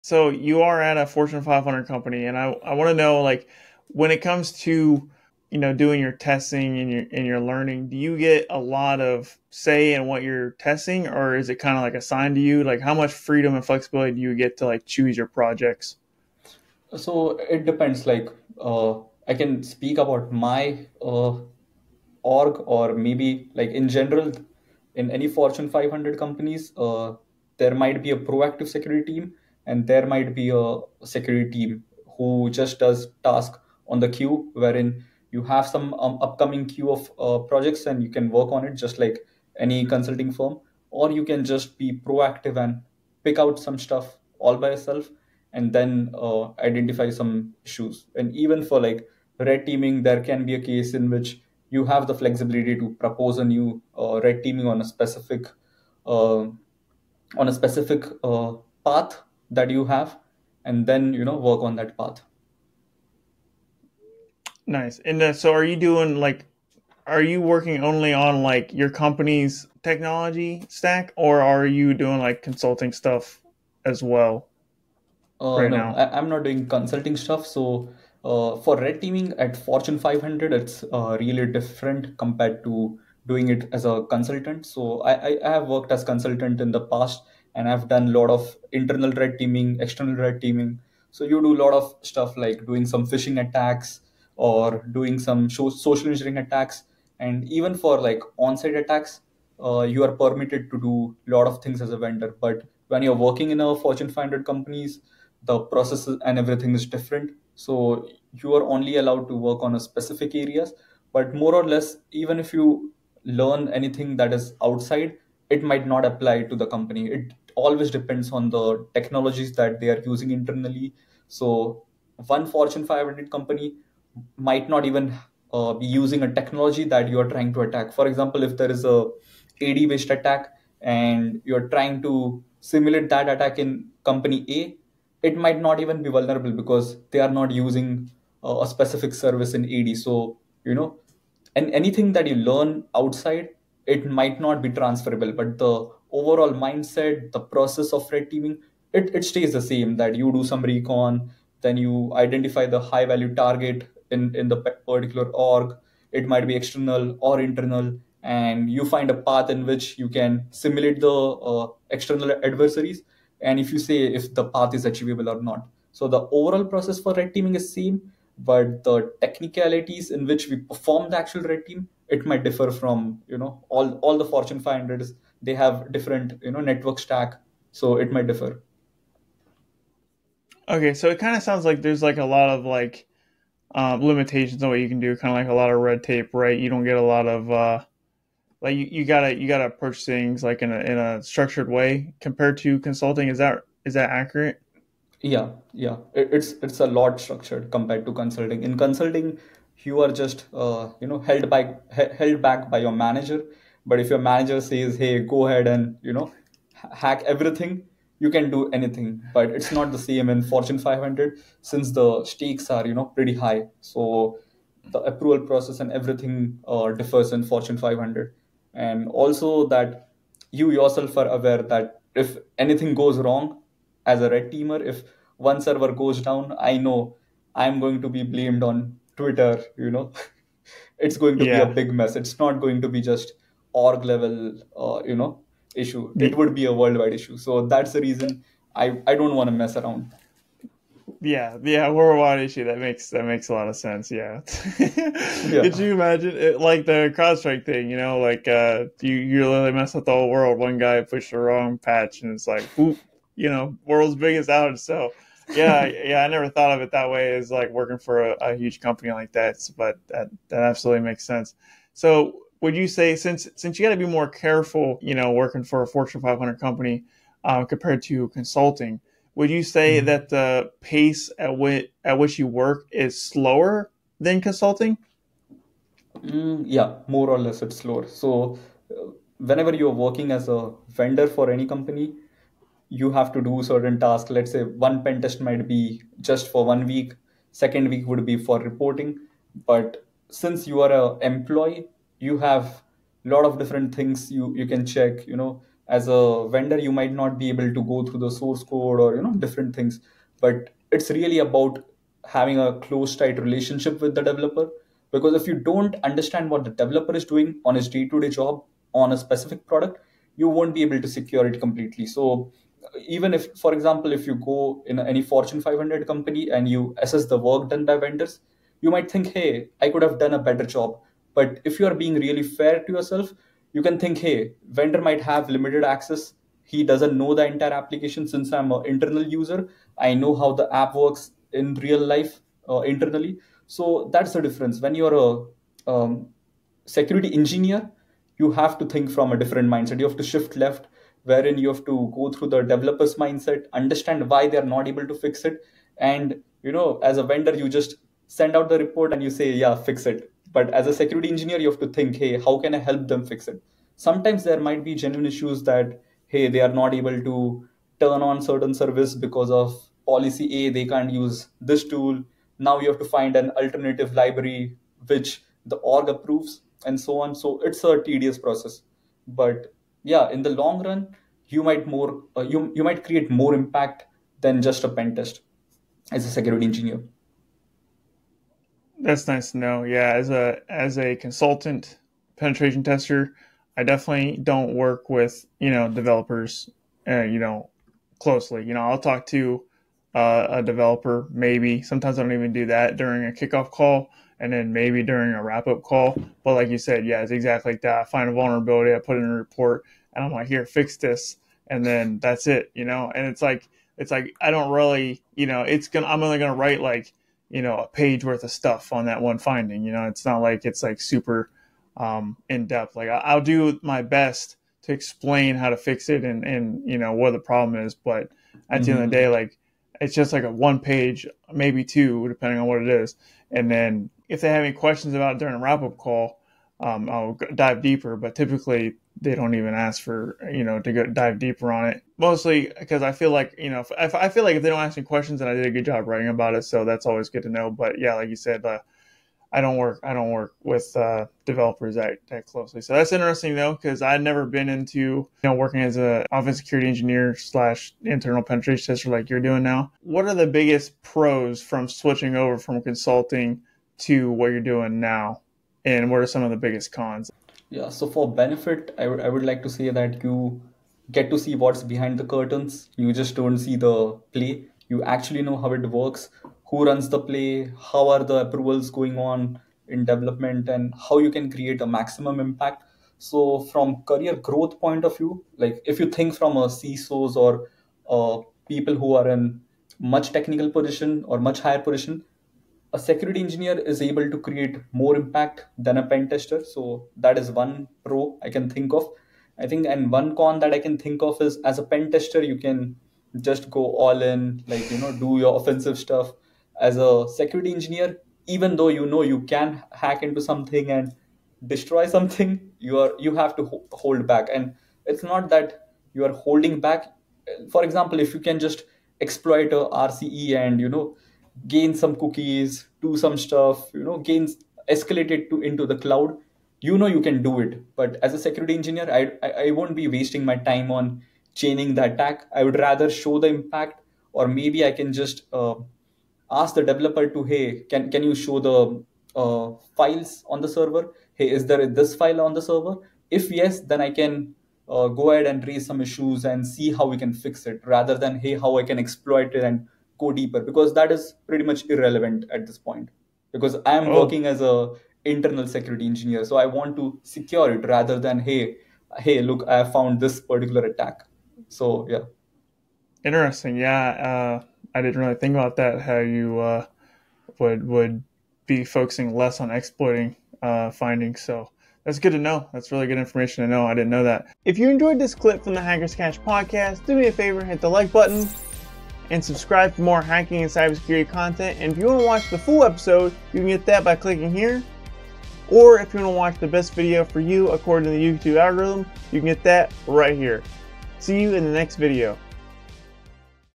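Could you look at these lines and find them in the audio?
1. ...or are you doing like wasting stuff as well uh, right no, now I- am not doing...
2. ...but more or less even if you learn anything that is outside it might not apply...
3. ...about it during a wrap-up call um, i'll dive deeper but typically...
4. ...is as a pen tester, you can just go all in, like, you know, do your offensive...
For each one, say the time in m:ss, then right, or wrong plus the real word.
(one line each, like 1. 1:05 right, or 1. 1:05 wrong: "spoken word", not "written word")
1. 1:11 wrong: "consulting", not "wasting"
2. 1:51 right
3. 7:05 right
4. 8:11 right.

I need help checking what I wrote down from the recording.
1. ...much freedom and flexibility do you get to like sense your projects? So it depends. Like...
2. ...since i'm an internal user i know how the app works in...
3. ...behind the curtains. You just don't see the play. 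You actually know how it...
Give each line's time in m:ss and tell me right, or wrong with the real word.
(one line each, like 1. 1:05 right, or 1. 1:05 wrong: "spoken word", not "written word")
1. 0:12 wrong: "choose", not "sense"
2. 5:28 right
3. 7:41 right.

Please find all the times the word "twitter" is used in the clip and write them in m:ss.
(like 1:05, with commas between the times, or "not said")
3:49.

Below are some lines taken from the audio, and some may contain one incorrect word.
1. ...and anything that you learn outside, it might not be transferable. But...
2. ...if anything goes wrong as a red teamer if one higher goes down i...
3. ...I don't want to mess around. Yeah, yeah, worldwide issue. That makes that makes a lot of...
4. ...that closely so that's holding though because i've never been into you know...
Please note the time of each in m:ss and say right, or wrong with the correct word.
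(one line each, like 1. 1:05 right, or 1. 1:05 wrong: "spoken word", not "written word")
1. 2:21 right
2. 3:42 wrong: "server", not "higher"
3. 3:59 right
4. 7:22 wrong: "interesting", not "holding".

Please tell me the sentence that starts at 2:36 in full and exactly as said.
It might be external or internal, and you find a path in which you can simulate the uh, external adversaries.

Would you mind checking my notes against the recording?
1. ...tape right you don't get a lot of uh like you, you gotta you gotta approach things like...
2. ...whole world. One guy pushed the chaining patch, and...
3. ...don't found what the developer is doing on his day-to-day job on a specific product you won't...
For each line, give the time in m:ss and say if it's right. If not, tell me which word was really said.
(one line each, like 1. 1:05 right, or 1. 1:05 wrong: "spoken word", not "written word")
1. 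3:06 right
2. 4:10 wrong: "wrong", not "chaining"
3. 5:05 wrong: "understand", not "found".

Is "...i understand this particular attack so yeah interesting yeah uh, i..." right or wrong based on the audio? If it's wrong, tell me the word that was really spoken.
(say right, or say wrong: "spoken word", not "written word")
wrong: "found", not "understand".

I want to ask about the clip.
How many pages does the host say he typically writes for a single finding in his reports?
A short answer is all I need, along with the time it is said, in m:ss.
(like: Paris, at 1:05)
1 page, at 6:47.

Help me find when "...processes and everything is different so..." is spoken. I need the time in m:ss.
1:45.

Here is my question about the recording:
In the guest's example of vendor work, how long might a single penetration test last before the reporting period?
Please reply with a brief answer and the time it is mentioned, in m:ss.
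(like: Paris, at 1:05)
1 week, at 4:46.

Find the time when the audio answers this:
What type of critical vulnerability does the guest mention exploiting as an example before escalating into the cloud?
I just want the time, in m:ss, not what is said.
8:29.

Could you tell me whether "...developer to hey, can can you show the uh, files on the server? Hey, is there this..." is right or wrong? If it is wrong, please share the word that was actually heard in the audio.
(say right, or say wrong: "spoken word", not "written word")
right.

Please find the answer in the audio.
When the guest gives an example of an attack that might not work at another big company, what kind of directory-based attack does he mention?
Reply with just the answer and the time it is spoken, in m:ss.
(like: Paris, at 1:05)
AD based attack, at 2:09.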